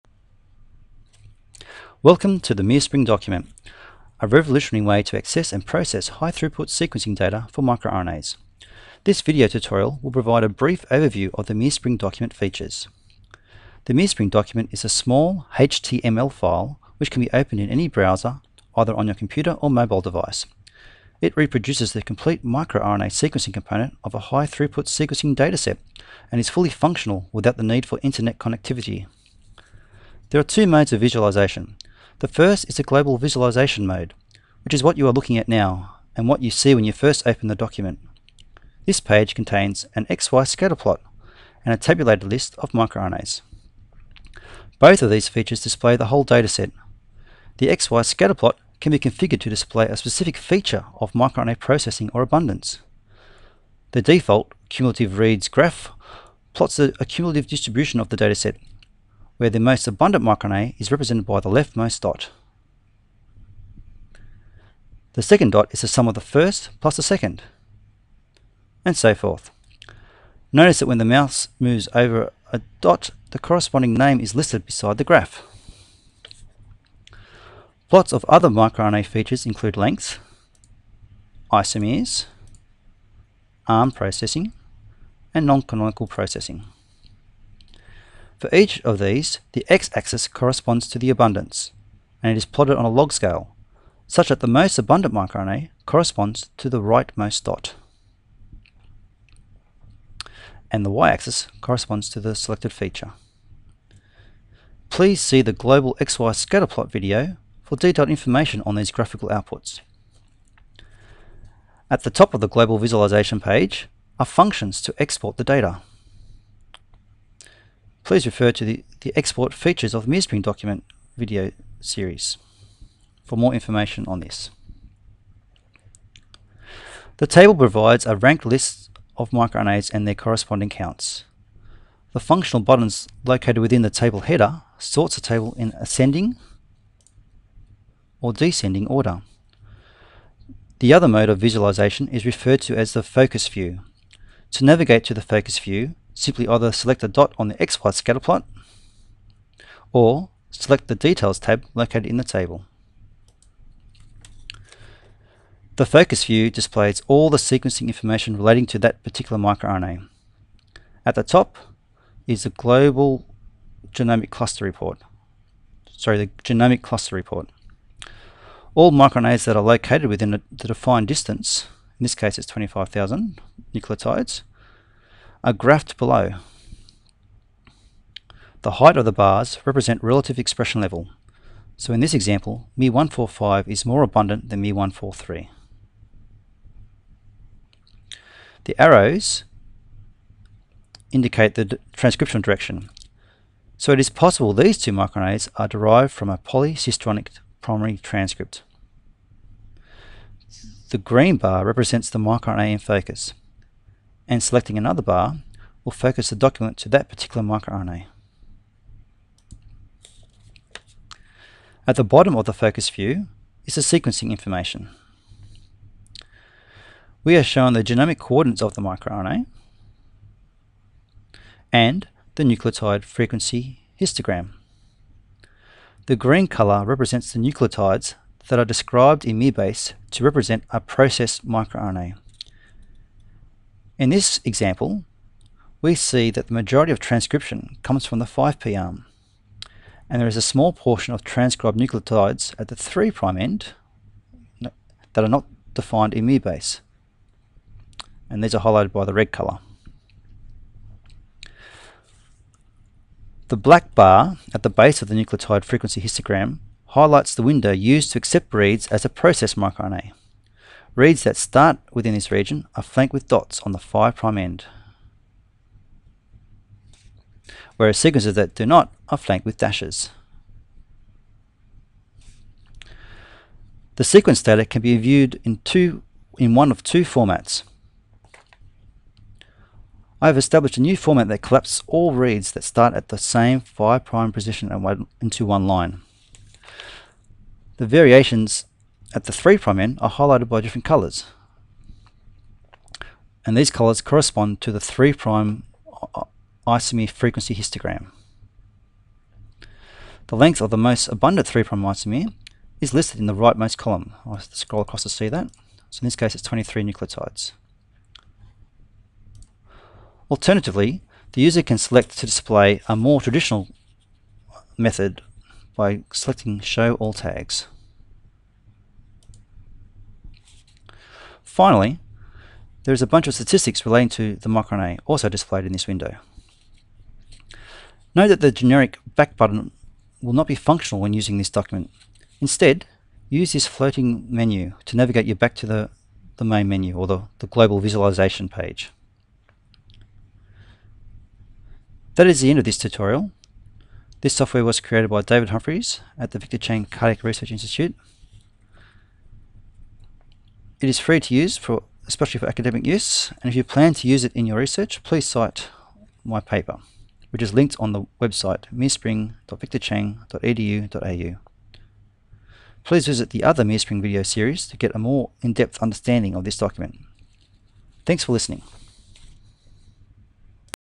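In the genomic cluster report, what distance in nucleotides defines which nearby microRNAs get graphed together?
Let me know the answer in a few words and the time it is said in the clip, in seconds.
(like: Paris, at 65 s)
25,000, at 172 s.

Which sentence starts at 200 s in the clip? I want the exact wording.
The green bar represents the microRNA in focus, and selecting another bar will focus the document to that particular microRNA.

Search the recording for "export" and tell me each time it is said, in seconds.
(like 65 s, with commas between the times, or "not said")
114 s, 119 s.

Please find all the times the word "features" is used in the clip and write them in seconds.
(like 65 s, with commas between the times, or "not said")
12 s, 45 s, 50 s, 79 s, 102 s, 119 s.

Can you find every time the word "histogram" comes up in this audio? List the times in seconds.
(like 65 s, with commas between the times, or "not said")
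223 s, 256 s, 297 s.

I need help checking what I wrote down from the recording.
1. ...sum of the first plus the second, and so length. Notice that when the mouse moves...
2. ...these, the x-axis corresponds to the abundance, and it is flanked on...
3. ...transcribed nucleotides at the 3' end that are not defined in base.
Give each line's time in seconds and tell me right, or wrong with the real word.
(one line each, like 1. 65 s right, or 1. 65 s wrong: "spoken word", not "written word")
1. 65 s wrong: "forth", not "length"
2. 88 s wrong: "plotted", not "flanked"
3. 241 s right.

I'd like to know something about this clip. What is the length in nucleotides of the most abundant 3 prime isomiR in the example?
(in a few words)
23.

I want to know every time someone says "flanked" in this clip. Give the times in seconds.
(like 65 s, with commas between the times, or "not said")
262 s, 269 s.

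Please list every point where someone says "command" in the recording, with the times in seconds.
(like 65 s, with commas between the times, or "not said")
not said.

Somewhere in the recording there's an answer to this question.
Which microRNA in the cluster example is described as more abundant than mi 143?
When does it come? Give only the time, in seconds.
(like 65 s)
182 s.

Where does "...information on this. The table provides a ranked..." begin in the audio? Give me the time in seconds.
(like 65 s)
123 s.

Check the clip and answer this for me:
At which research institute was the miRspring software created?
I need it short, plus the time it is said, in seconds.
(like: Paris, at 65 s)
Victor Chang Cardiac Research Institute, at 346 s.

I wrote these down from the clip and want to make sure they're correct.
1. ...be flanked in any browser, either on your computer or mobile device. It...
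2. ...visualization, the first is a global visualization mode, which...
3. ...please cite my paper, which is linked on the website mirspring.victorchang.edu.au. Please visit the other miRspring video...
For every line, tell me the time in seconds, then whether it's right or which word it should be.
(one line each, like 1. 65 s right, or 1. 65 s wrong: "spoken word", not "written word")
1. 17 s wrong: "opened", not "flanked"
2. 31 s right
3. 355 s right.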